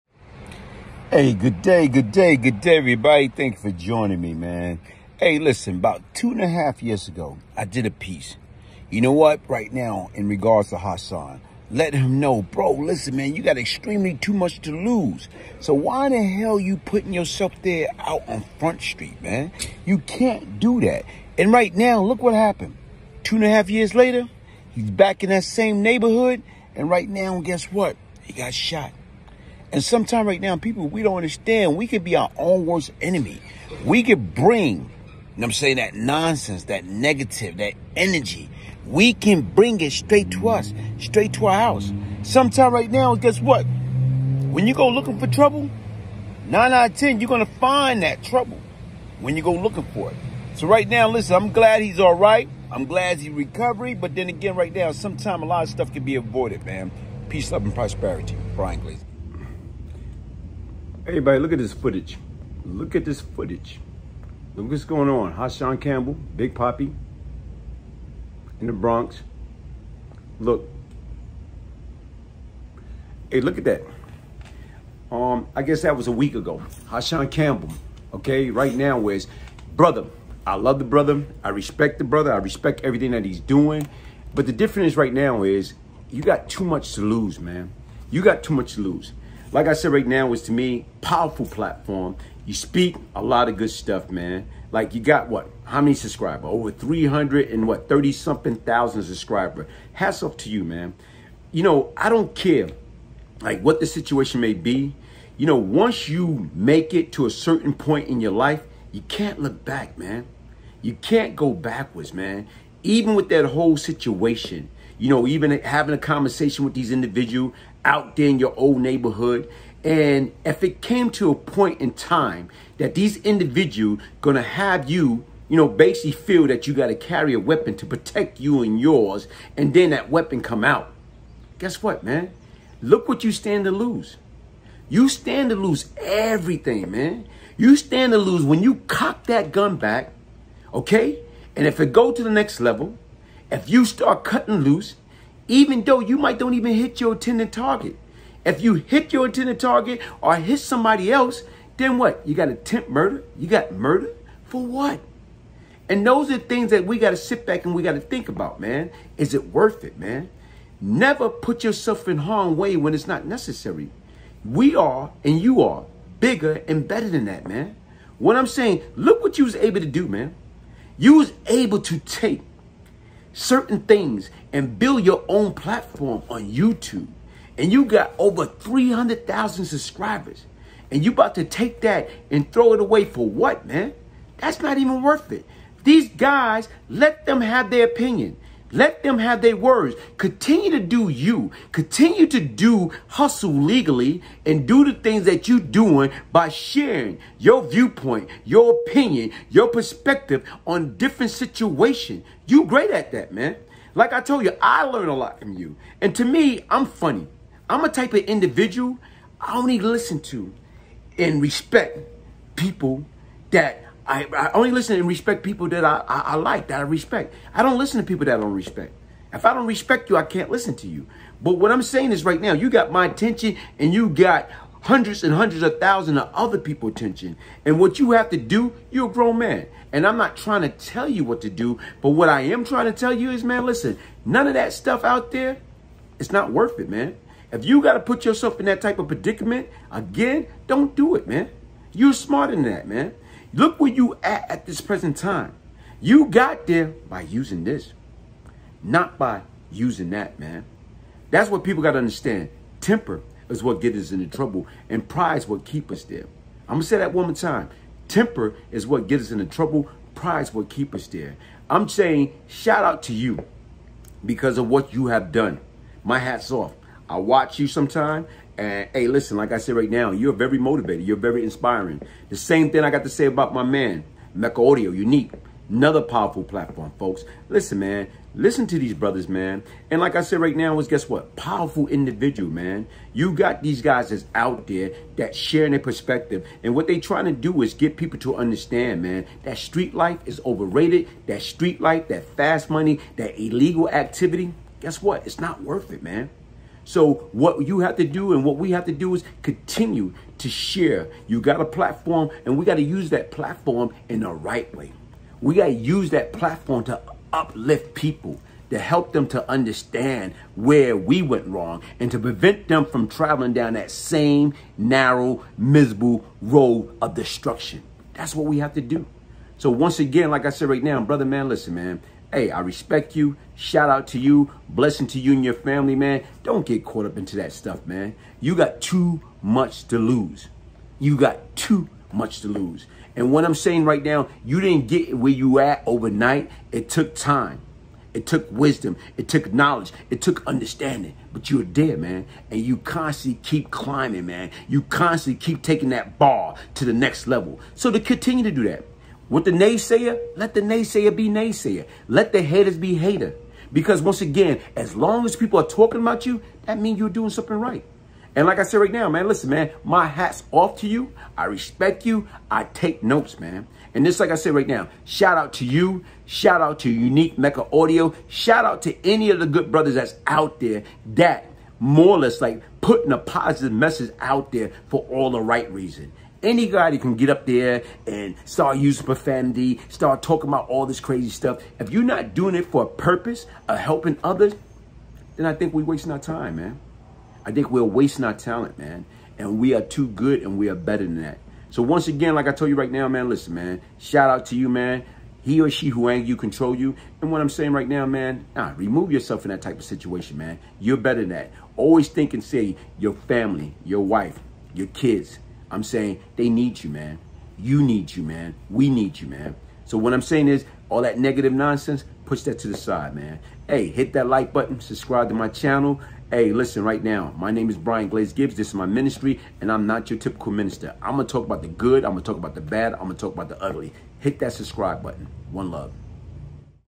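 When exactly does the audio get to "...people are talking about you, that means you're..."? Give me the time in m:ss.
5:55.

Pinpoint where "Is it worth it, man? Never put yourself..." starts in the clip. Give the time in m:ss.
2:39.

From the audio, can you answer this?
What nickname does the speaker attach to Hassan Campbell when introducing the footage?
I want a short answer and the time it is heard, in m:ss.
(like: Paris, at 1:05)
Big Poppy, at 1:06.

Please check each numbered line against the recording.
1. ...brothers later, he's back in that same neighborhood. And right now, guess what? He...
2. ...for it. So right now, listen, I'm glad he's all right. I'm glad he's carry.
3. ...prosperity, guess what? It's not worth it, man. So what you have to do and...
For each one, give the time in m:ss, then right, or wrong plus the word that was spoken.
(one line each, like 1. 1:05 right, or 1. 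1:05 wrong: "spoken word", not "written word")
1. 0:23 wrong: "years", not "brothers"
2. 0:49 wrong: "recovery", not "carry"
3. 4:53 wrong: "activity", not "prosperity".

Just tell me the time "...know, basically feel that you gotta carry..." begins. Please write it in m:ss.
2:05.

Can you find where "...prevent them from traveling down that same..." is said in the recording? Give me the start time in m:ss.
5:12.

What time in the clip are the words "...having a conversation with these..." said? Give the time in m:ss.
1:55.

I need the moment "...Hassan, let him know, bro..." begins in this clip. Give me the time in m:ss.
0:10.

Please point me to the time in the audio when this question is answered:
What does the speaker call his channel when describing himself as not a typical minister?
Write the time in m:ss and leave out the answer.
6:58.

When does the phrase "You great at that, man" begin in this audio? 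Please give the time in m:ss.
3:22.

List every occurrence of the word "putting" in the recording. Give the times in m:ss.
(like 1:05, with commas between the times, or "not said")
0:16, 6:12.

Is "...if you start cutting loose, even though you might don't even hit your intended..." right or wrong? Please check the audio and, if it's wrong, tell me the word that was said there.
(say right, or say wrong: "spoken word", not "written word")
right.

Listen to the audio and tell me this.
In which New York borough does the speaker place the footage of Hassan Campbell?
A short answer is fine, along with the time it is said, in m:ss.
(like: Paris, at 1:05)
The Bronx, at 1:08.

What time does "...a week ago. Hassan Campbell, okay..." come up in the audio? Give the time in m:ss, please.
1:16.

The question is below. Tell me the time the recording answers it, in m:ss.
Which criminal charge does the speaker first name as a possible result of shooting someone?
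2:32.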